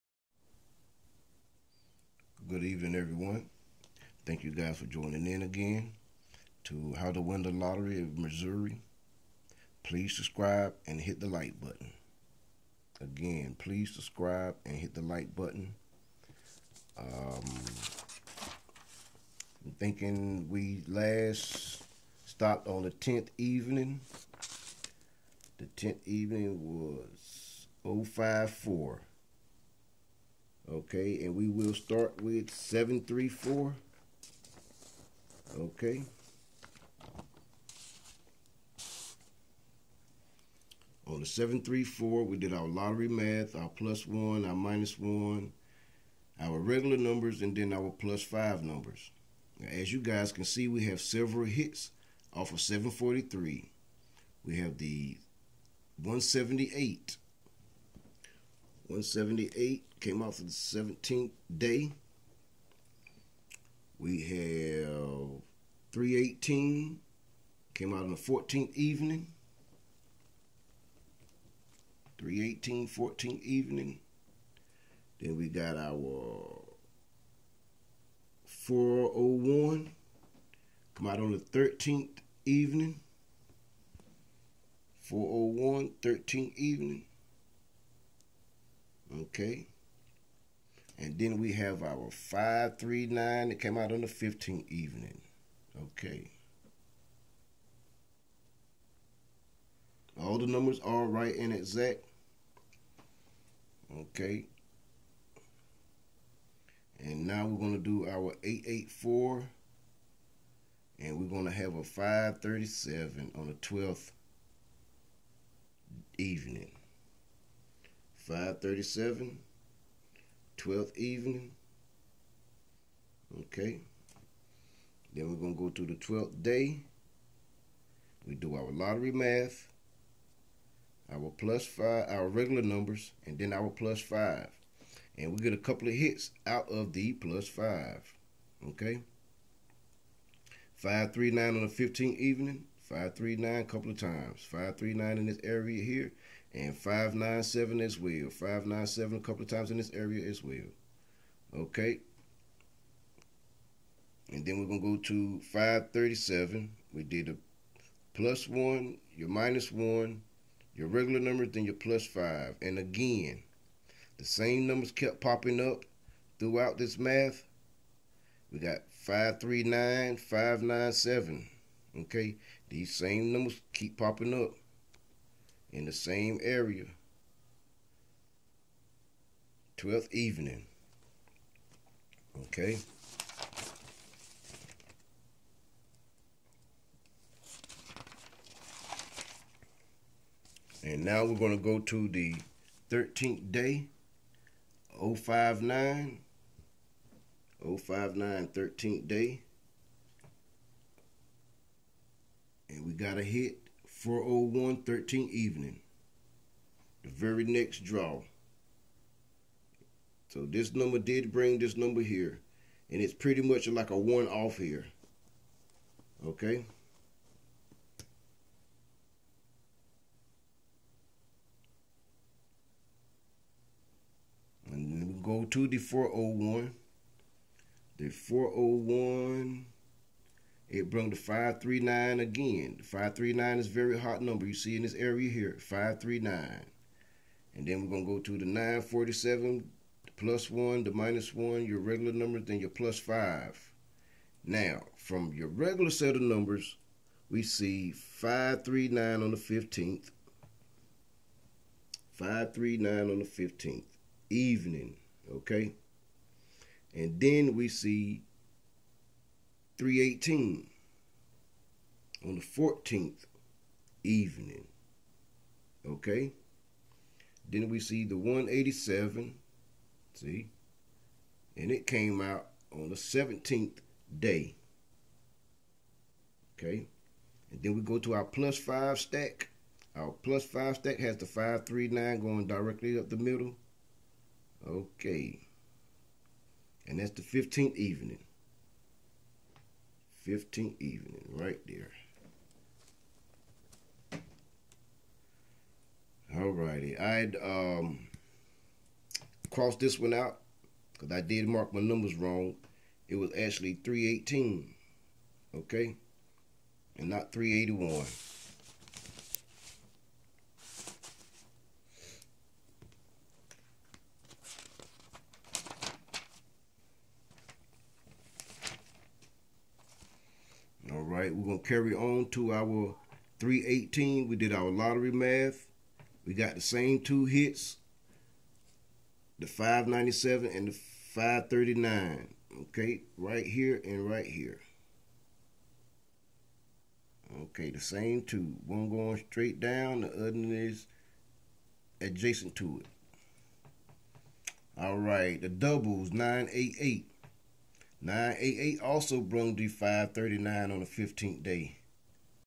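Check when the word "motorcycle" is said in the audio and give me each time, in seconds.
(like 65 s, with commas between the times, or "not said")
not said.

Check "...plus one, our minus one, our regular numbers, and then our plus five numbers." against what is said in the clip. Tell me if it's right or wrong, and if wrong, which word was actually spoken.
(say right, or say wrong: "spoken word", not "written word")
right.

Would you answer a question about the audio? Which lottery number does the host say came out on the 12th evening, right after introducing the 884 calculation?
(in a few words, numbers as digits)
537.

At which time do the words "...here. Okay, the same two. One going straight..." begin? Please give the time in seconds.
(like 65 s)
334 s.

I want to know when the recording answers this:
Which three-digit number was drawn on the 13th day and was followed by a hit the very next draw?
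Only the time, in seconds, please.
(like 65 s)
194 s.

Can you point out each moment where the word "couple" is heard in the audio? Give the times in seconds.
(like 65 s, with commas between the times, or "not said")
135 s, 143 s, 149 s.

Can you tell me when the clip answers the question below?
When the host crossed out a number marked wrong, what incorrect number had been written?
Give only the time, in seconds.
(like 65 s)
307 s.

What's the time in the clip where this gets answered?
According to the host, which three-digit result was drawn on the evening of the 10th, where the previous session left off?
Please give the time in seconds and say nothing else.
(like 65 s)
27 s.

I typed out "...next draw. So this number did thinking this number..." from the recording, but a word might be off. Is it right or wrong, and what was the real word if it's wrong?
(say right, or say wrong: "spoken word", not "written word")
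wrong: "bring", not "thinking".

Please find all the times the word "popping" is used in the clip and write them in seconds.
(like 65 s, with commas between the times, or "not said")
165 s, 173 s.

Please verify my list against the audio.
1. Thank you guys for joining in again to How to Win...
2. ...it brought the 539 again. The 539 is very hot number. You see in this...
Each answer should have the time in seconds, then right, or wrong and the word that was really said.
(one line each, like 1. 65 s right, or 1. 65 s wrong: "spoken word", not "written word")
1. 4 s right
2. 230 s right.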